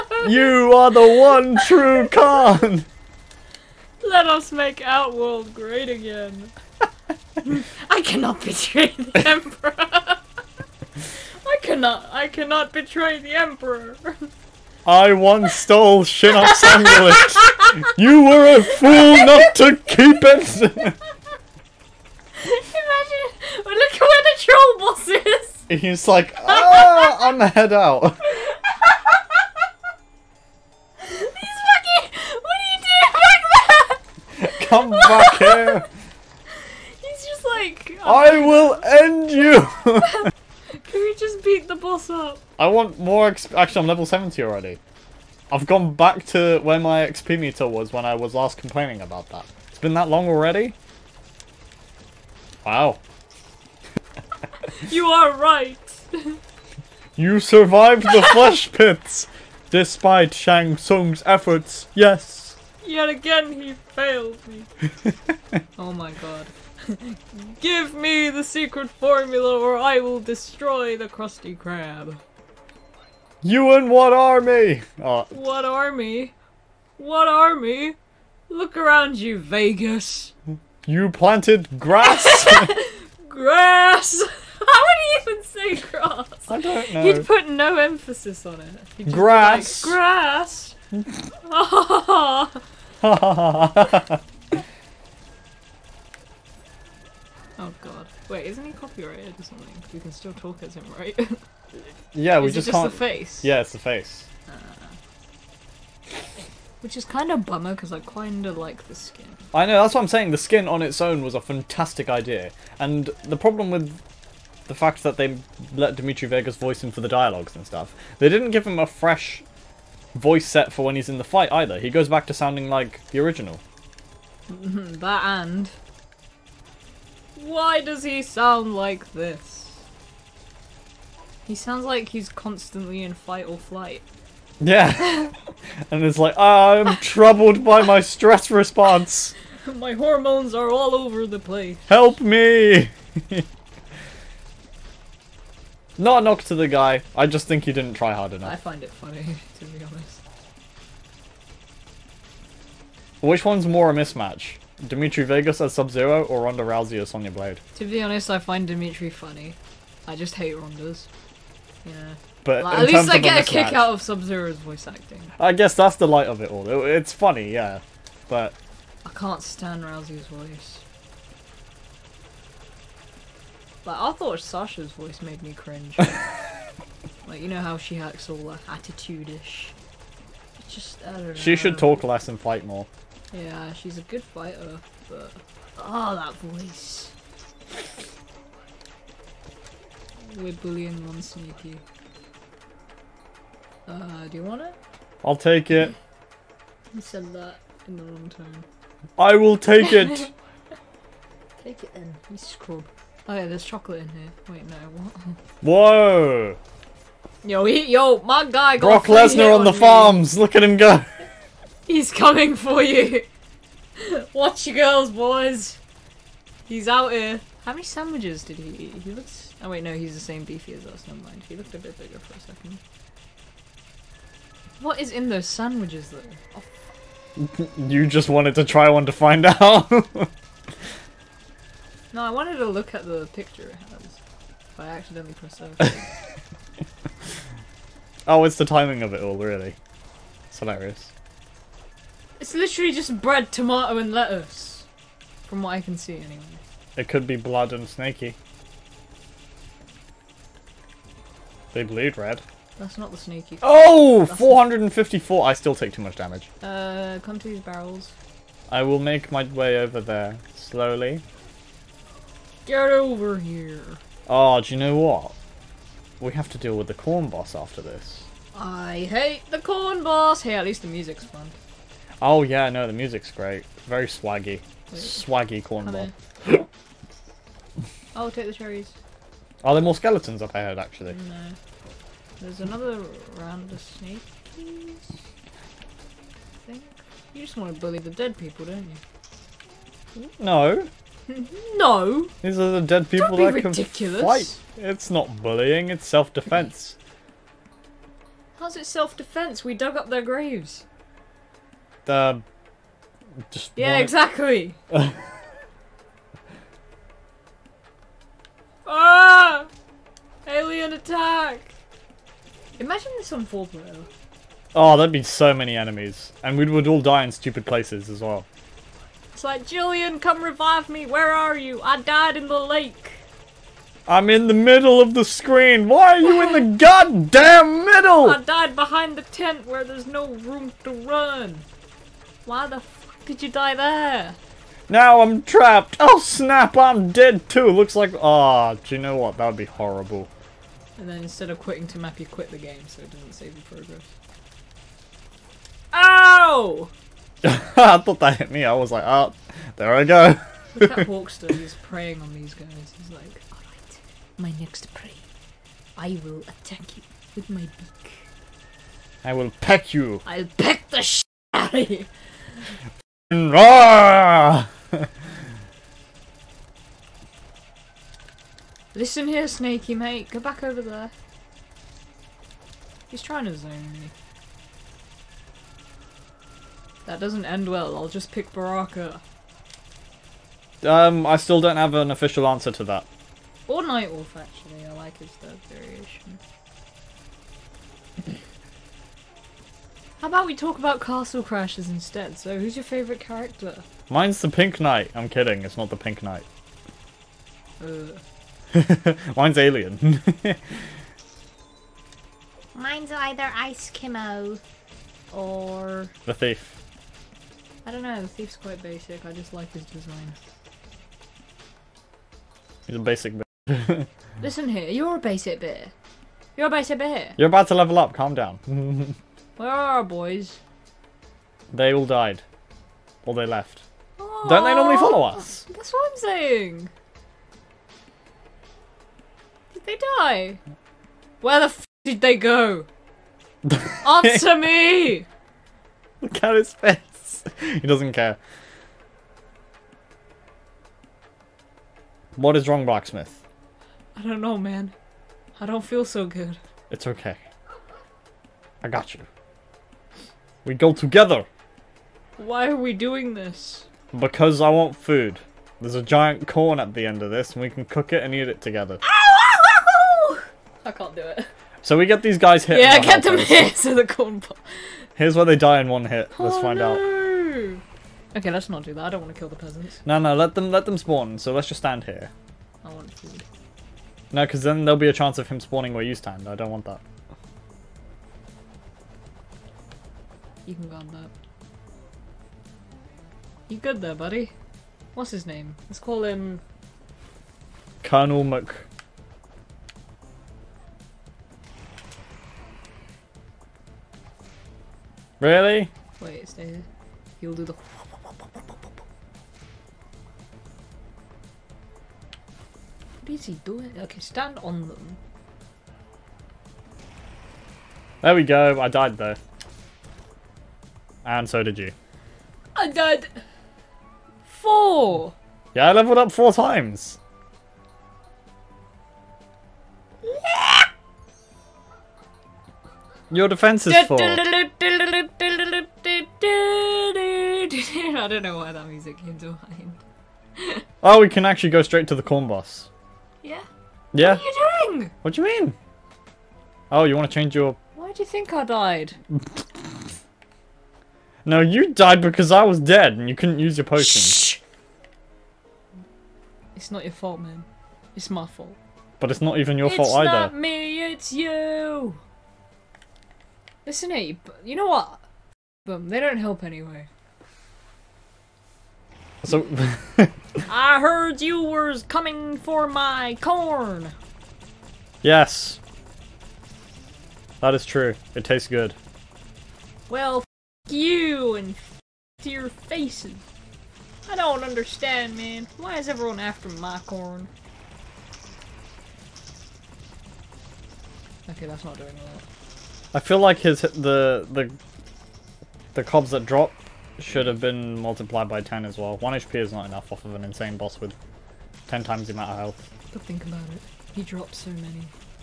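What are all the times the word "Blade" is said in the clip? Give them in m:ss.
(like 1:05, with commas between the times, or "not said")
2:37.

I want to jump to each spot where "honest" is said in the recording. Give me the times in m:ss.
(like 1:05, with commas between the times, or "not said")
2:29, 2:38.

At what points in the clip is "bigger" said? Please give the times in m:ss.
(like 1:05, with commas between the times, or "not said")
3:41.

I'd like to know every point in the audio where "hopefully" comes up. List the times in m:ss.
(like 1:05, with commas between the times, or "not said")
not said.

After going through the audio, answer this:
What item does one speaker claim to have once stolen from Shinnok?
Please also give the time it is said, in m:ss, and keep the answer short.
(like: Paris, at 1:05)
Shinnok's amulet, at 0:16.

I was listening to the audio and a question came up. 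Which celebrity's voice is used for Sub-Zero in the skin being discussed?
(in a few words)
Dimitri Vegas.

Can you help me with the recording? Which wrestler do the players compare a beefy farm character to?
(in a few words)
Brock Lesnar.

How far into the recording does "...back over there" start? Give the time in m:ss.
6:10.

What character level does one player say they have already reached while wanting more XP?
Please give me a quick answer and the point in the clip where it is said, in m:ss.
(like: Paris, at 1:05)
70, at 0:43.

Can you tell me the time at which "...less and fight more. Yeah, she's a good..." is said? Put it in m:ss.
3:02.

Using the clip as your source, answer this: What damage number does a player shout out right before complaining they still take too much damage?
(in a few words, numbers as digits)
454.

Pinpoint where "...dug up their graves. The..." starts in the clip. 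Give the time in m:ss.
4:59.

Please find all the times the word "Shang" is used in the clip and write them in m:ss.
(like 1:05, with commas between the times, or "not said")
1:00.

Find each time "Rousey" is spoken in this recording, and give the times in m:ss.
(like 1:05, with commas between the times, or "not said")
2:36, 2:49.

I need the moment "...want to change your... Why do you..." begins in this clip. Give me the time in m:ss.
8:57.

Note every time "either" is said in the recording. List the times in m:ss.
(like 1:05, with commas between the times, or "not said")
2:01, 6:43, 9:10.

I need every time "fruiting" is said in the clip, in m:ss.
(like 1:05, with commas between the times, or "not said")
not said.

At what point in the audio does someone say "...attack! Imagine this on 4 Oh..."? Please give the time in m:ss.
5:10.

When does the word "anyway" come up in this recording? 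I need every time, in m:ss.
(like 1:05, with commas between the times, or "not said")
4:06, 9:16.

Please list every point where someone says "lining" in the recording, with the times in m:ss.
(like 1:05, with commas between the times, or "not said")
not said.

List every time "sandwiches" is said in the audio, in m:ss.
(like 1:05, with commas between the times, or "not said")
3:37, 3:45.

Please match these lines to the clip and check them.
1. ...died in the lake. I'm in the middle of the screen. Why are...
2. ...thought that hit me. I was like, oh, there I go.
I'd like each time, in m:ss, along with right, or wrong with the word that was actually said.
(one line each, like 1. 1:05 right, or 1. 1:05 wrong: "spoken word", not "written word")
1. 5:22 right
2. 5:47 right.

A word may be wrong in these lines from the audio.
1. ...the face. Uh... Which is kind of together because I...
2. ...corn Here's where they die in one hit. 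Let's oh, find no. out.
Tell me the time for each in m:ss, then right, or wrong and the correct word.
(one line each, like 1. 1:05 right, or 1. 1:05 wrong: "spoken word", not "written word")
1. 1:43 wrong: "bummer", not "together"
2. 7:44 right.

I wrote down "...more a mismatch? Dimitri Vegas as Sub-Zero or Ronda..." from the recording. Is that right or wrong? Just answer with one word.
right.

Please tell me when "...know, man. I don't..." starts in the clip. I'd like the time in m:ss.
7:24.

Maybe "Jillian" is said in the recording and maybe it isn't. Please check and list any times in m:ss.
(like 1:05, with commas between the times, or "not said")
5:19.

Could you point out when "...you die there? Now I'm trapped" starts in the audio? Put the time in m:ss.
5:33.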